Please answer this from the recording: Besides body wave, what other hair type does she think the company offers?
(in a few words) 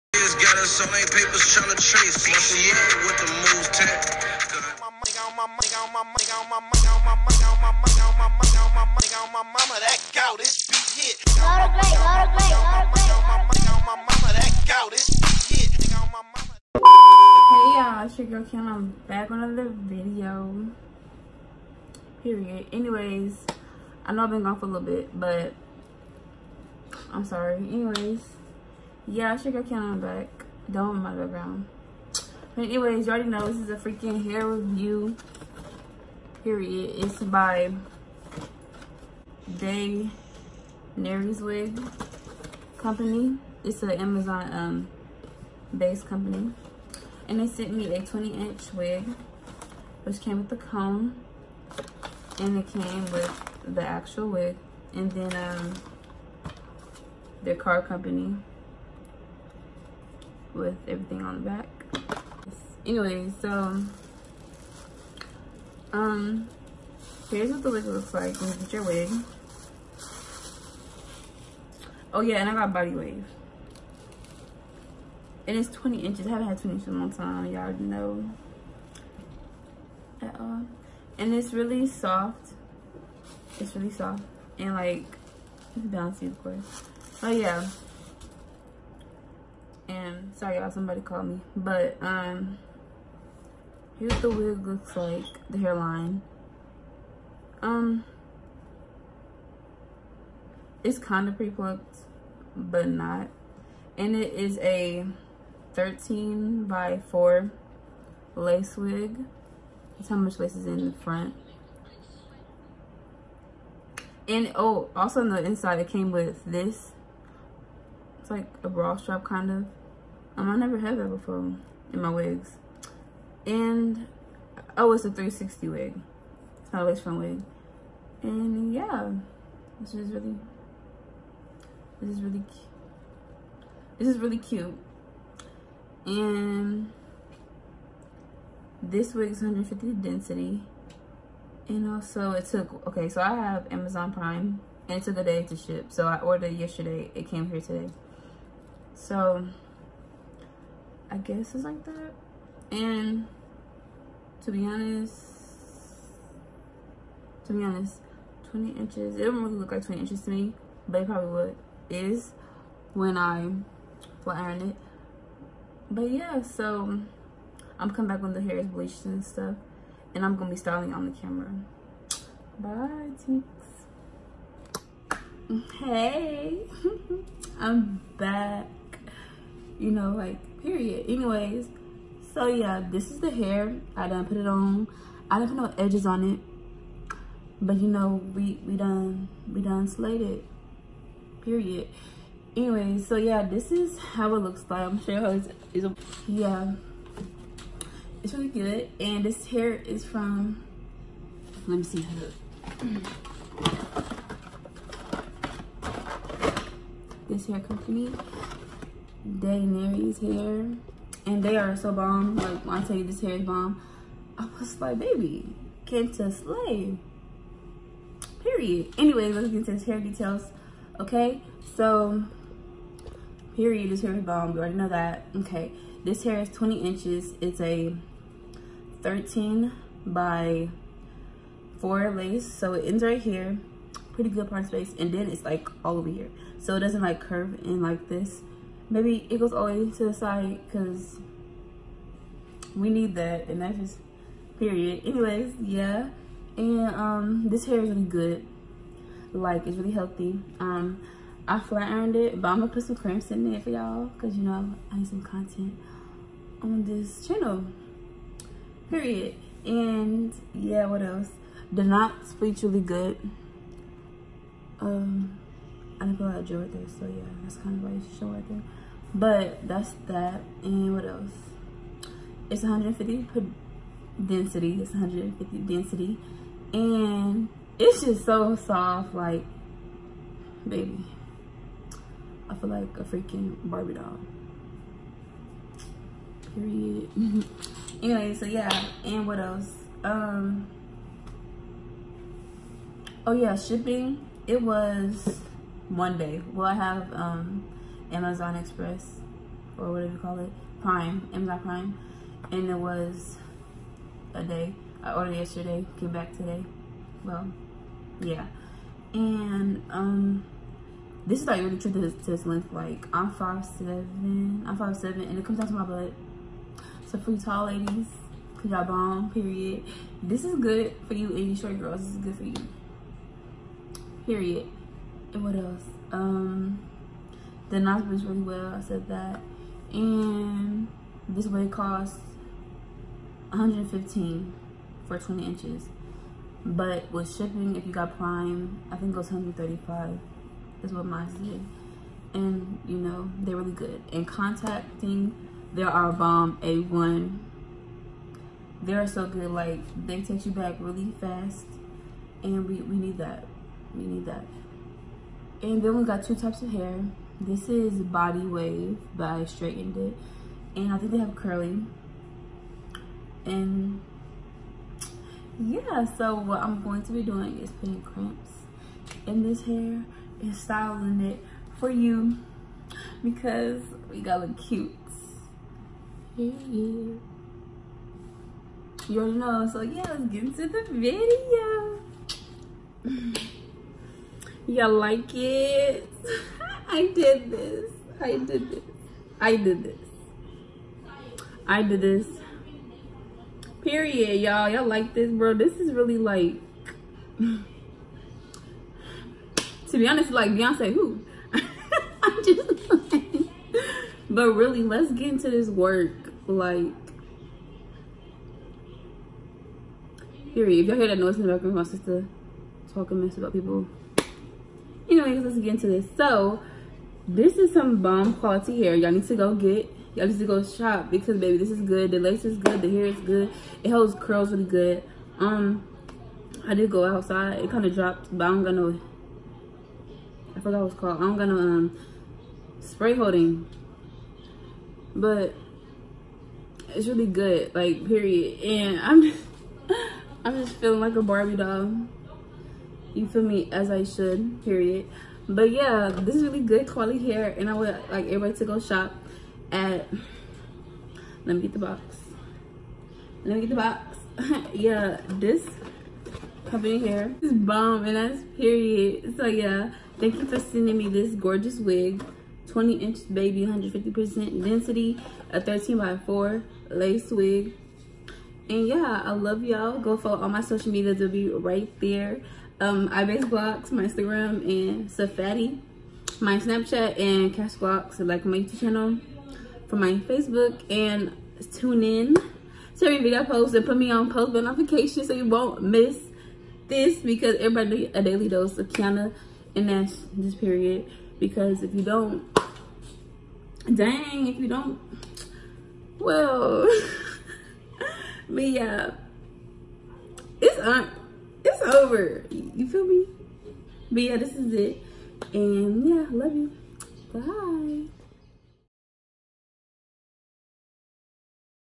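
Curly.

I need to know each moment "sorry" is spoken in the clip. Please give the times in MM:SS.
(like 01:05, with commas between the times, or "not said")
00:27, 01:30.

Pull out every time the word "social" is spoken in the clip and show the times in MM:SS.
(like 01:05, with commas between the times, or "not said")
07:50.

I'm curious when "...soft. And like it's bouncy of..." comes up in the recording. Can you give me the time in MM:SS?
01:23.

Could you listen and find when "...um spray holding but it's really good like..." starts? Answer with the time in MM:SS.
07:11.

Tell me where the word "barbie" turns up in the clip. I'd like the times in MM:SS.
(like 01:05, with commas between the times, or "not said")
04:43, 07:21.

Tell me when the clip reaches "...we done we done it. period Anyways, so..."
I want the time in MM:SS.
03:08.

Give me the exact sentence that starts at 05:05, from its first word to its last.
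I uh, ordered yesterday, came back today.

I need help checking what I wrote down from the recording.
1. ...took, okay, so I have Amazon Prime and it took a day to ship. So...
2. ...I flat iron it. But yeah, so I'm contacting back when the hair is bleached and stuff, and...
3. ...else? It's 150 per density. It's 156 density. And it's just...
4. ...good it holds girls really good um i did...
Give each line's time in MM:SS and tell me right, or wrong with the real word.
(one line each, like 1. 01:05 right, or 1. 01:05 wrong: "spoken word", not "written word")
1. 02:22 right
2. 02:43 wrong: "coming", not "contacting"
3. 04:31 wrong: "150", not "156"
4. 07:03 wrong: "curls", not "girls".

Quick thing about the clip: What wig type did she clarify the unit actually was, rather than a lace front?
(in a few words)
360 wig.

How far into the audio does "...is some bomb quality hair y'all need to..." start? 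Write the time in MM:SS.
06:57.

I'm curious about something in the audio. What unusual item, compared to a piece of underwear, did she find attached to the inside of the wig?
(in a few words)
Bra strap.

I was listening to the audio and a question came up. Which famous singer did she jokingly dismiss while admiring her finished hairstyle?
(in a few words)
Beyonce.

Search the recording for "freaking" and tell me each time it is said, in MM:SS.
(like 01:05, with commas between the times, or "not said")
00:33, 04:43.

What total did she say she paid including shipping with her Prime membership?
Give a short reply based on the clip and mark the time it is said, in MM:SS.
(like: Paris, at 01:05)
135, at 05:39.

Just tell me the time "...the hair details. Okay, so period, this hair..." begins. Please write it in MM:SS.
03:39.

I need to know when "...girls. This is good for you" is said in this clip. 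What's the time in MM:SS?
05:21.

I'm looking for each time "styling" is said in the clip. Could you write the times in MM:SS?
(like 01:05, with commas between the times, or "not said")
02:50, 06:10.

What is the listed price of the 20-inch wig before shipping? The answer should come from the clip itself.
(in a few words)
115.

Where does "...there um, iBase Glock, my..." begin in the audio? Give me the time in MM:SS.
07:51.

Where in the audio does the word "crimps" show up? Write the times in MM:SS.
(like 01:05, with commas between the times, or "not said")
04:12, 06:08.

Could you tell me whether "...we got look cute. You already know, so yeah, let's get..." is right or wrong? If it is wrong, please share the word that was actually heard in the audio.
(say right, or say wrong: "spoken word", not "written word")
right.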